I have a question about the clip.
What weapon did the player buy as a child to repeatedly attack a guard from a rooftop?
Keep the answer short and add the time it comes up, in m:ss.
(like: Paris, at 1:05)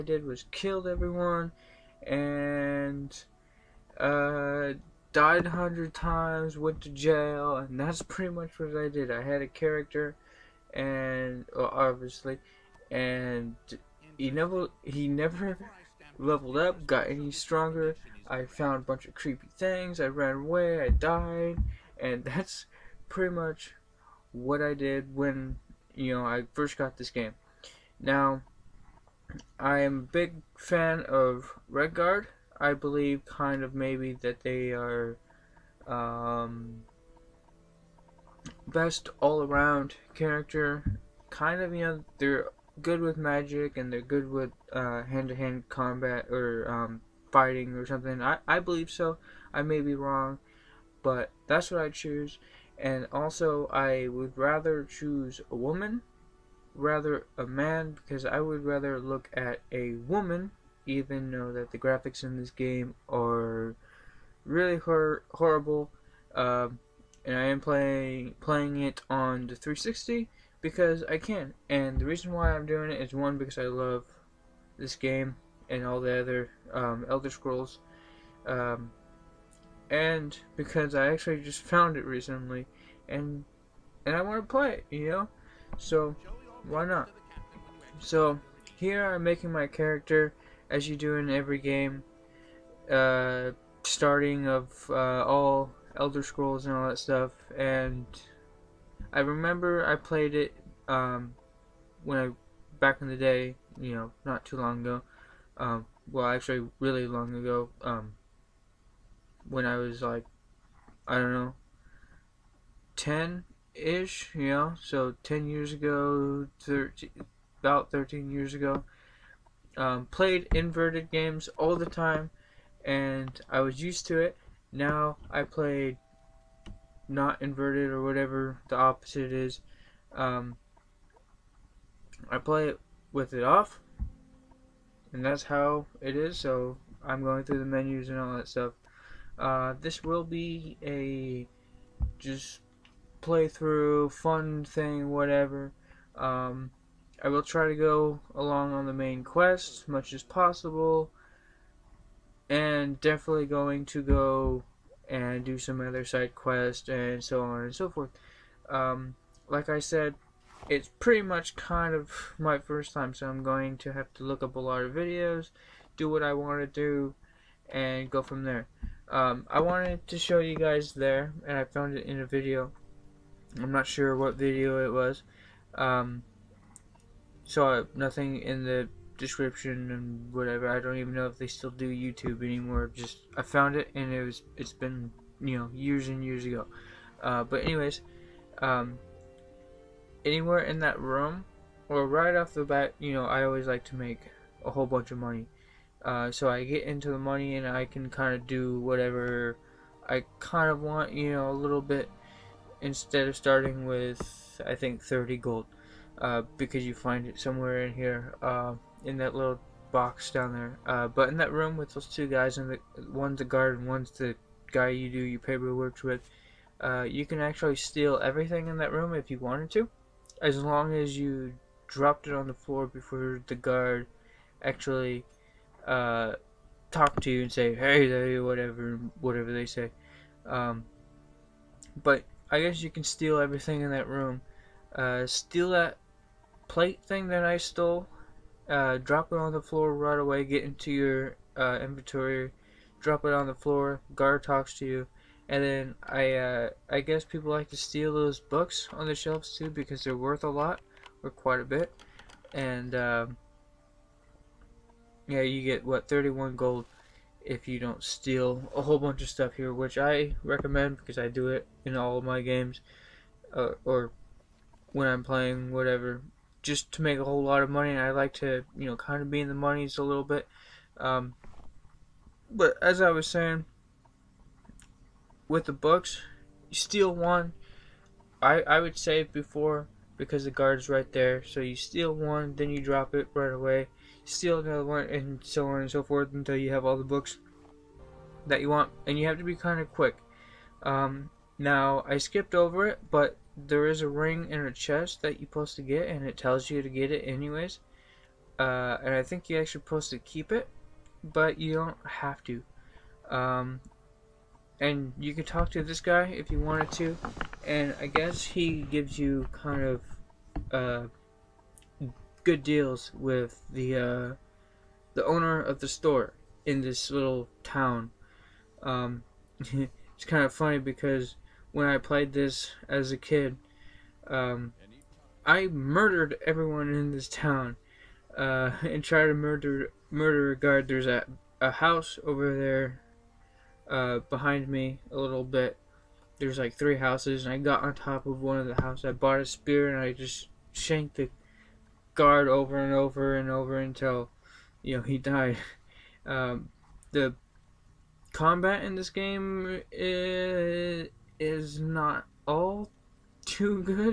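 a spear, at 5:39.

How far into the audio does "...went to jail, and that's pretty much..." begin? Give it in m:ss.
0:06.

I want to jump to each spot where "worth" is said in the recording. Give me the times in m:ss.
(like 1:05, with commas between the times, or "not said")
4:10.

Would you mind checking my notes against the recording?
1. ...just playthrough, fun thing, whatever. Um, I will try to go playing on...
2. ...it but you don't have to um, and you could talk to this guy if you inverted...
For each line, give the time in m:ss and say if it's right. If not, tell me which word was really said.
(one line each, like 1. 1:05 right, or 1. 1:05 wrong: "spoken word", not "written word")
1. 2:22 wrong: "along", not "playing"
2. 5:00 wrong: "wanted", not "inverted".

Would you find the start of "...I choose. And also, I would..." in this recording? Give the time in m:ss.
0:51.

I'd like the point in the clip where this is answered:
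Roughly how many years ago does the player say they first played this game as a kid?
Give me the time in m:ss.
1:57.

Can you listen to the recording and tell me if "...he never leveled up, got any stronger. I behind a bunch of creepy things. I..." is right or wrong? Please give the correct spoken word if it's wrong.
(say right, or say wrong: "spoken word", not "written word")
wrong: "found", not "behind".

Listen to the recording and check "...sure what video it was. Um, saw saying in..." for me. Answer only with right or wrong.
wrong.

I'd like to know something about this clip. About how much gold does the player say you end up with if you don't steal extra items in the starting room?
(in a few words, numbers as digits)
31.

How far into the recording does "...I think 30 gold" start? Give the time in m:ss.
3:24.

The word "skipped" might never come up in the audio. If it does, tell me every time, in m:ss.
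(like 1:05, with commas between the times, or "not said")
4:52.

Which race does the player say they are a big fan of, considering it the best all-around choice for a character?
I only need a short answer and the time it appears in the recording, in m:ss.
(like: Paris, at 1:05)
Redguard, at 0:31.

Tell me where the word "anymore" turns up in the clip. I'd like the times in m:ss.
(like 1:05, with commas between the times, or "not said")
3:02.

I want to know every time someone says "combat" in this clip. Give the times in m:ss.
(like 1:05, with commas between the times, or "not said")
0:45, 5:48.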